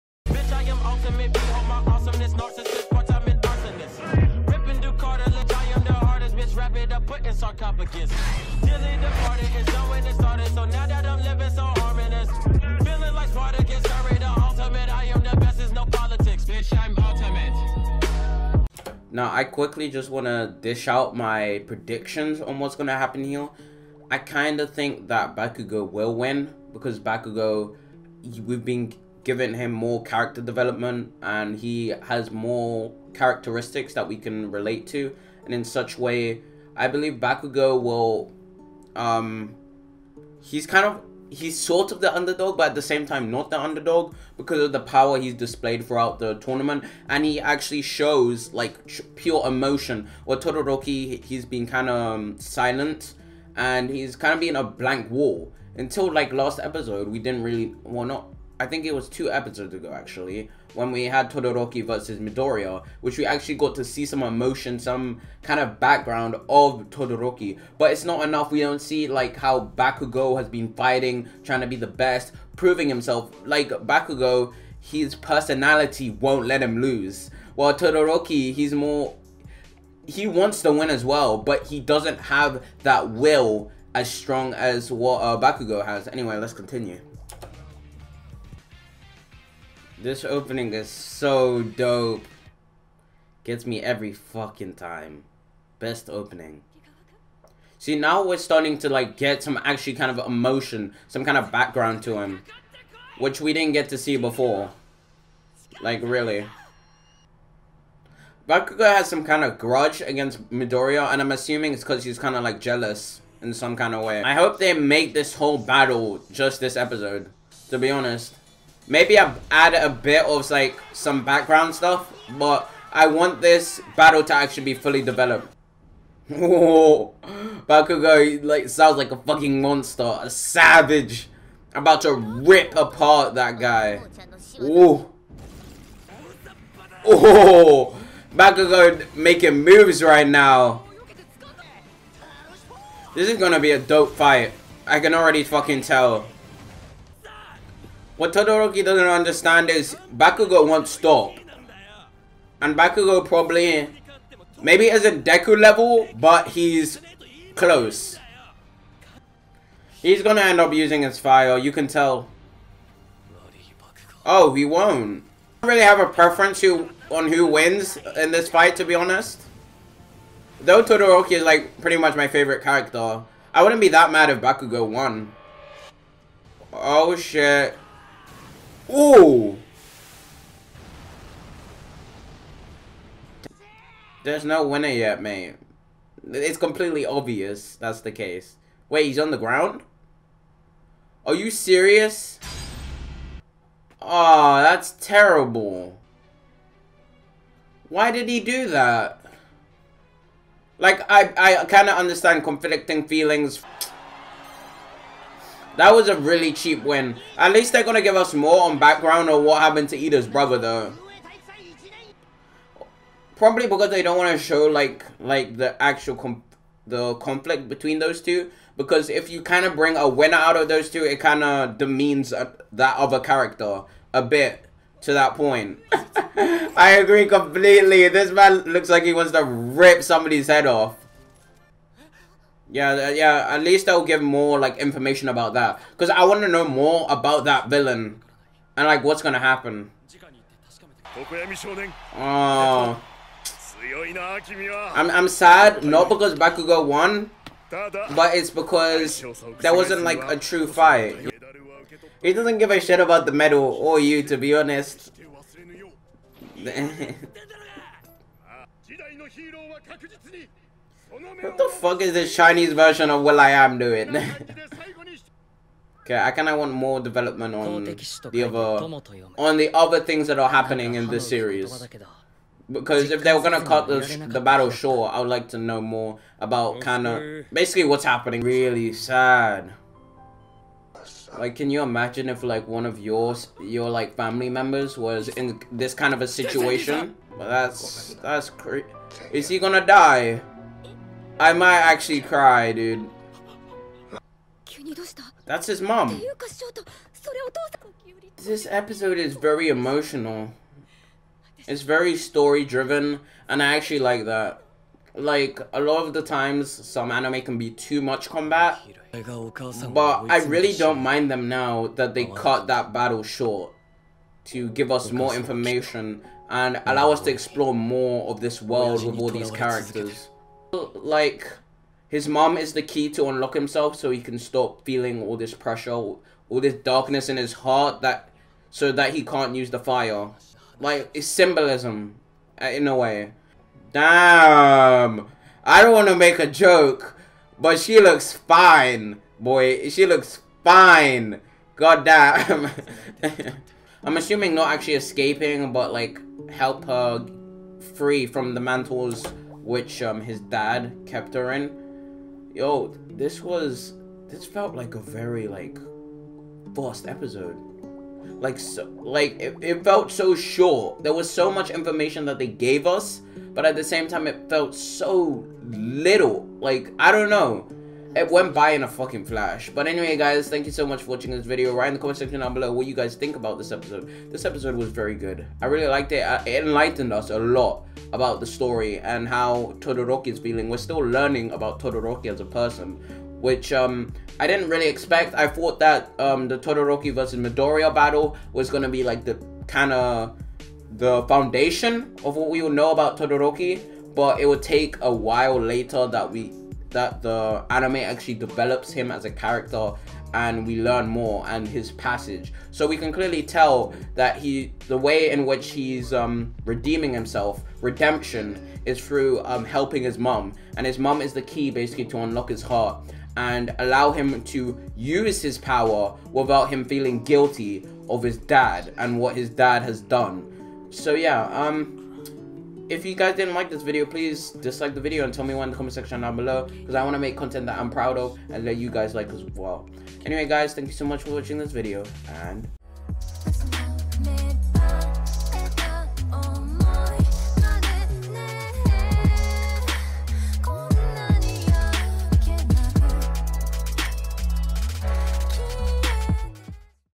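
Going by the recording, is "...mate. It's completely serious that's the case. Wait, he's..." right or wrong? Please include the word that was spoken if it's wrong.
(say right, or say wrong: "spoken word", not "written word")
wrong: "obvious", not "serious".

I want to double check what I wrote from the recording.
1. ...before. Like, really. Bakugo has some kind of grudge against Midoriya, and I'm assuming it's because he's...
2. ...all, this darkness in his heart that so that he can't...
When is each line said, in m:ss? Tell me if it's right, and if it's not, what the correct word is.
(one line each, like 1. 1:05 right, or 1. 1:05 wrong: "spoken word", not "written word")
1. 1:44 right
2. 5:25 right.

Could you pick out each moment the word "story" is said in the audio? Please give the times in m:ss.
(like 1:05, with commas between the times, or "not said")
5:02, 6:18.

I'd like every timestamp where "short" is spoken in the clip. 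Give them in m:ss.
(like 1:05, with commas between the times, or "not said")
4:34, 5:13, 6:00.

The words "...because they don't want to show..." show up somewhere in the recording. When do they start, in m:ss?
3:33.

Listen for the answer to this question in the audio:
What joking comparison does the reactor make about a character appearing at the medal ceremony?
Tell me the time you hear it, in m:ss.
4:22.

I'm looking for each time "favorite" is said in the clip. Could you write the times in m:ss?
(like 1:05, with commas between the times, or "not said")
2:52.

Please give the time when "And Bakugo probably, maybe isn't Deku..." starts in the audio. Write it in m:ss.
2:32.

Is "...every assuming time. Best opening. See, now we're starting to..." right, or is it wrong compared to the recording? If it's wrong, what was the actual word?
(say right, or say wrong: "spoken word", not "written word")
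wrong: "fucking", not "assuming".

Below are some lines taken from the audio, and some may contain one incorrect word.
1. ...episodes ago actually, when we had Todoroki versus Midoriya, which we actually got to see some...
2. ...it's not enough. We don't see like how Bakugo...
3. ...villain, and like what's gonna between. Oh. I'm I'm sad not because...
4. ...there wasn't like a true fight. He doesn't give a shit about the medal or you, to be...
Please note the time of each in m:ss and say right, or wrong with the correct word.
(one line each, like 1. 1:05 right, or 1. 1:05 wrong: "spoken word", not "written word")
1. 0:59 right
2. 1:07 right
3. 3:57 wrong: "happen", not "between"
4. 4:09 right.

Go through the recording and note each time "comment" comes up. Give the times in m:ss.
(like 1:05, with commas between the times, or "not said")
6:11, 7:05.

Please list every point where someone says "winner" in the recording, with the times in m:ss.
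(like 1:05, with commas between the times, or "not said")
3:04, 3:40.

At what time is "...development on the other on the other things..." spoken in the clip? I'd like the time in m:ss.
4:27.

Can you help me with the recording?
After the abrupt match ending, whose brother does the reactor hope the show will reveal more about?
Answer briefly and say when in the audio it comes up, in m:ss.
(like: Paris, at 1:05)
Iida, at 3:29.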